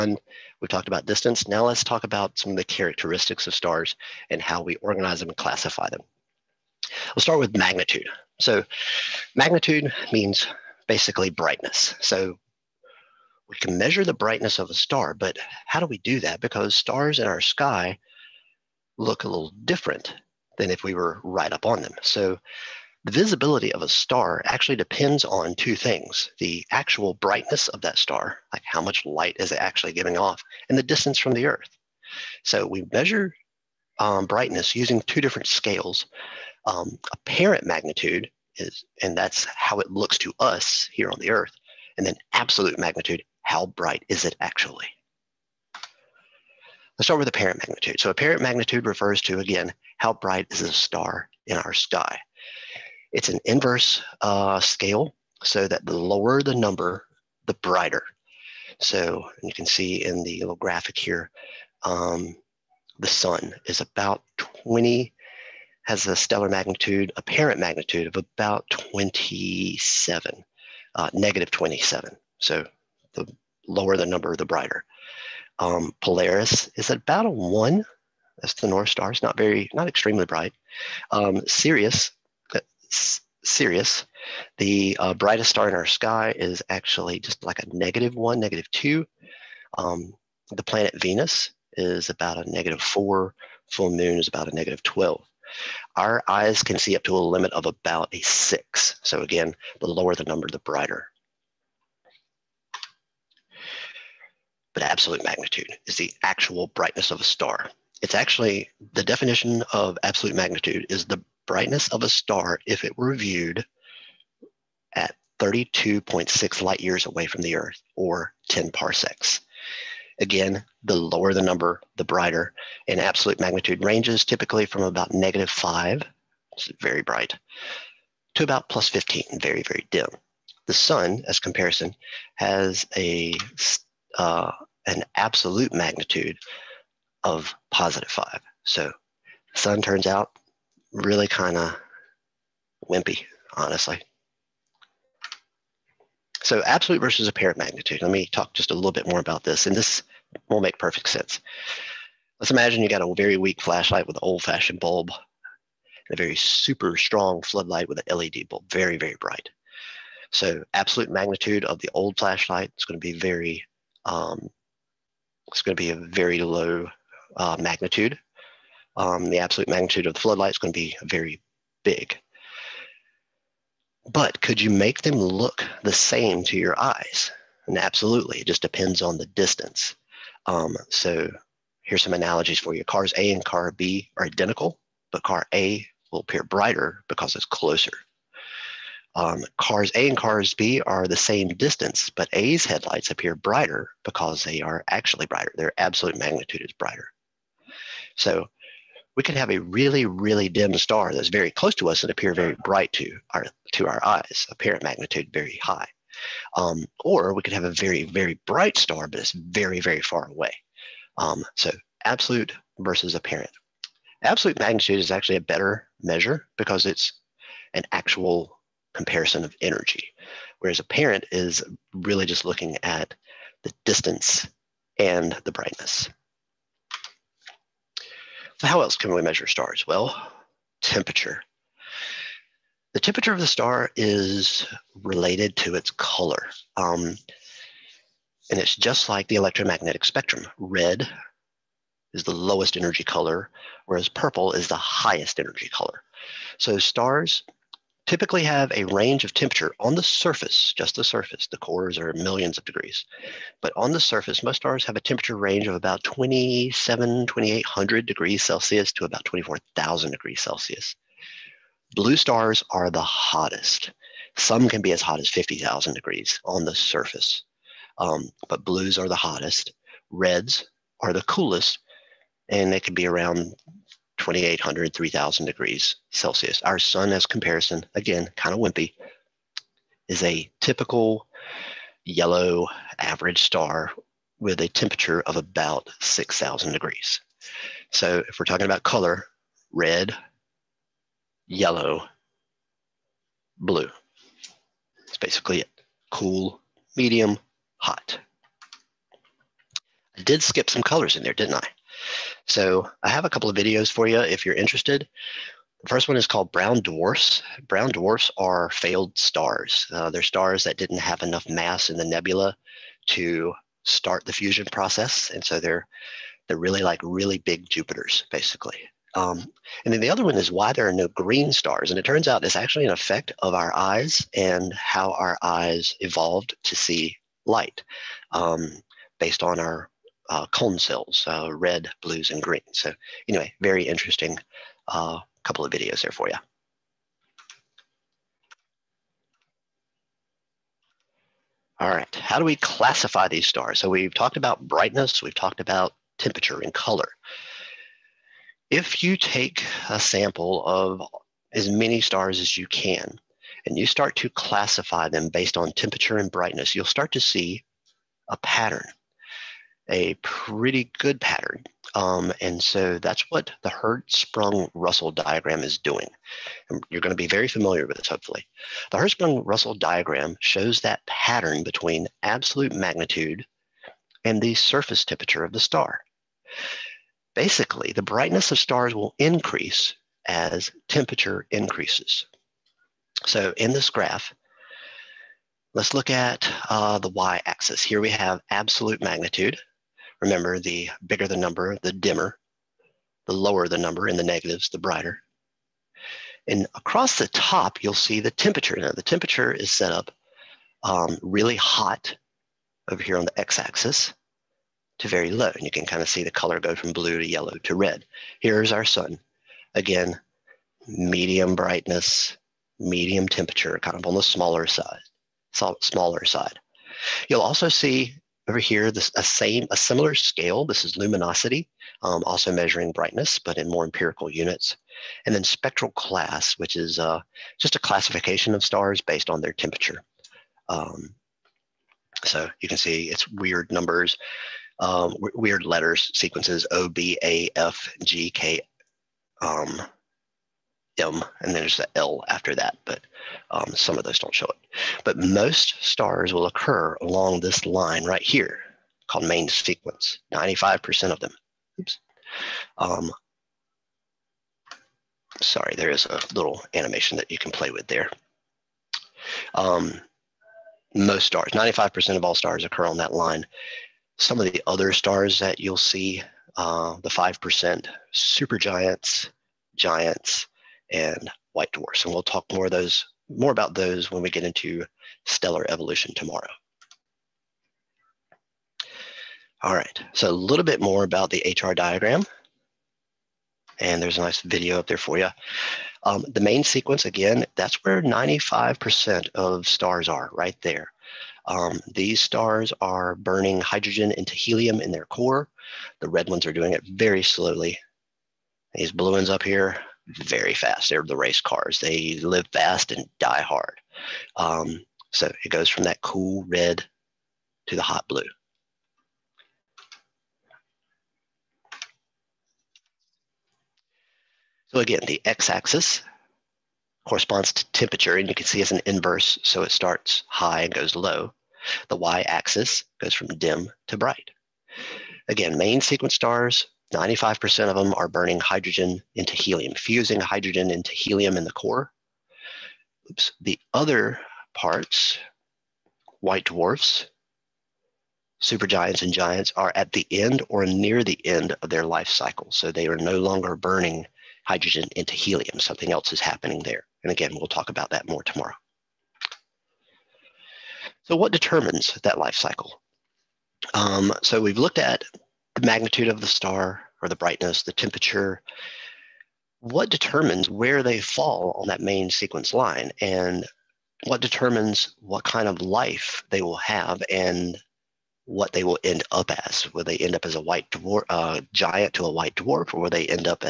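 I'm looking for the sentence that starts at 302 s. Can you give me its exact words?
So I have a couple of videos for you if you're interested.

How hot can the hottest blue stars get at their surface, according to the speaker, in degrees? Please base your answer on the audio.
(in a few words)
50,000.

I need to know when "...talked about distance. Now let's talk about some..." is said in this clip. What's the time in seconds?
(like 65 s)
0 s.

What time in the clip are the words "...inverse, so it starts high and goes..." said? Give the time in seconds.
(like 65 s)
518 s.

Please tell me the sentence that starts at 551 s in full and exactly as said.
So what determines that life cycle?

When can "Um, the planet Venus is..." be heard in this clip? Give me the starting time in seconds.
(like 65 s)
89 s.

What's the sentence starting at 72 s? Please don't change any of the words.
So the lower the number, the brighter.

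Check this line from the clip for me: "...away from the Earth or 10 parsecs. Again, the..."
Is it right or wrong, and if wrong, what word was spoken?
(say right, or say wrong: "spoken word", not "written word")
right.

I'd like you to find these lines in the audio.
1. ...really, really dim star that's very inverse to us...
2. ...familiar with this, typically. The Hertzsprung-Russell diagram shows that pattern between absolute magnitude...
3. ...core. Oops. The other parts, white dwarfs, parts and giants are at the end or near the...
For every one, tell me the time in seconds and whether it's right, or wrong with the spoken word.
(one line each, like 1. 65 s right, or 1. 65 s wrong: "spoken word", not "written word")
1. 199 s wrong: "close", not "inverse"
2. 367 s wrong: "hopefully", not "typically"
3. 531 s wrong: "supergiants", not "parts".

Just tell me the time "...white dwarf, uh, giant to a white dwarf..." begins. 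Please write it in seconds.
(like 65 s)
570 s.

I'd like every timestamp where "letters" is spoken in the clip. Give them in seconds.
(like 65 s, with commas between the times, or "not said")
435 s.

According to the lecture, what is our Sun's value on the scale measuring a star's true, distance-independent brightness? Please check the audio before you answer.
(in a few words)
positive 5.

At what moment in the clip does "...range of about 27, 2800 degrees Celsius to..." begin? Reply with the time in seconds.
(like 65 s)
255 s.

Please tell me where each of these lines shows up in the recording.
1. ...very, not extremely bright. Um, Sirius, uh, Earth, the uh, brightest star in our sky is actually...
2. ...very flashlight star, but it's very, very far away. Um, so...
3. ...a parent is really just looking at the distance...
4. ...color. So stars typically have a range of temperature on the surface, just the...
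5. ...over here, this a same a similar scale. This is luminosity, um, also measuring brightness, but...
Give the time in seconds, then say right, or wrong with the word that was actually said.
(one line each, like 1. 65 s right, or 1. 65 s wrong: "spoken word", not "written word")
1. 79 s wrong: "Sirius", not "Earth"
2. 208 s wrong: "bright", not "flashlight"
3. 220 s right
4. 245 s right
5. 418 s right.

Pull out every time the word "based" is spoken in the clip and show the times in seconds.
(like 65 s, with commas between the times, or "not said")
329 s, 355 s, 429 s.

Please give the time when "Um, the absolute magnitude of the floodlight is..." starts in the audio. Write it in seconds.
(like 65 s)
168 s.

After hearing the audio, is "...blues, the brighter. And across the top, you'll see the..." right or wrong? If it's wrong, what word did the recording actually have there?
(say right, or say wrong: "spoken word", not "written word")
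wrong: "negatives", not "blues".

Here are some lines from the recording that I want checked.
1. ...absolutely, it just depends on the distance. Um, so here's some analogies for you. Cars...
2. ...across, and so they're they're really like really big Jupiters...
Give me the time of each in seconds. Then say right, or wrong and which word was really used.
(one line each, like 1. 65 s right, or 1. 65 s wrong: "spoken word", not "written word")
1. 177 s right
2. 314 s wrong: "process", not "across".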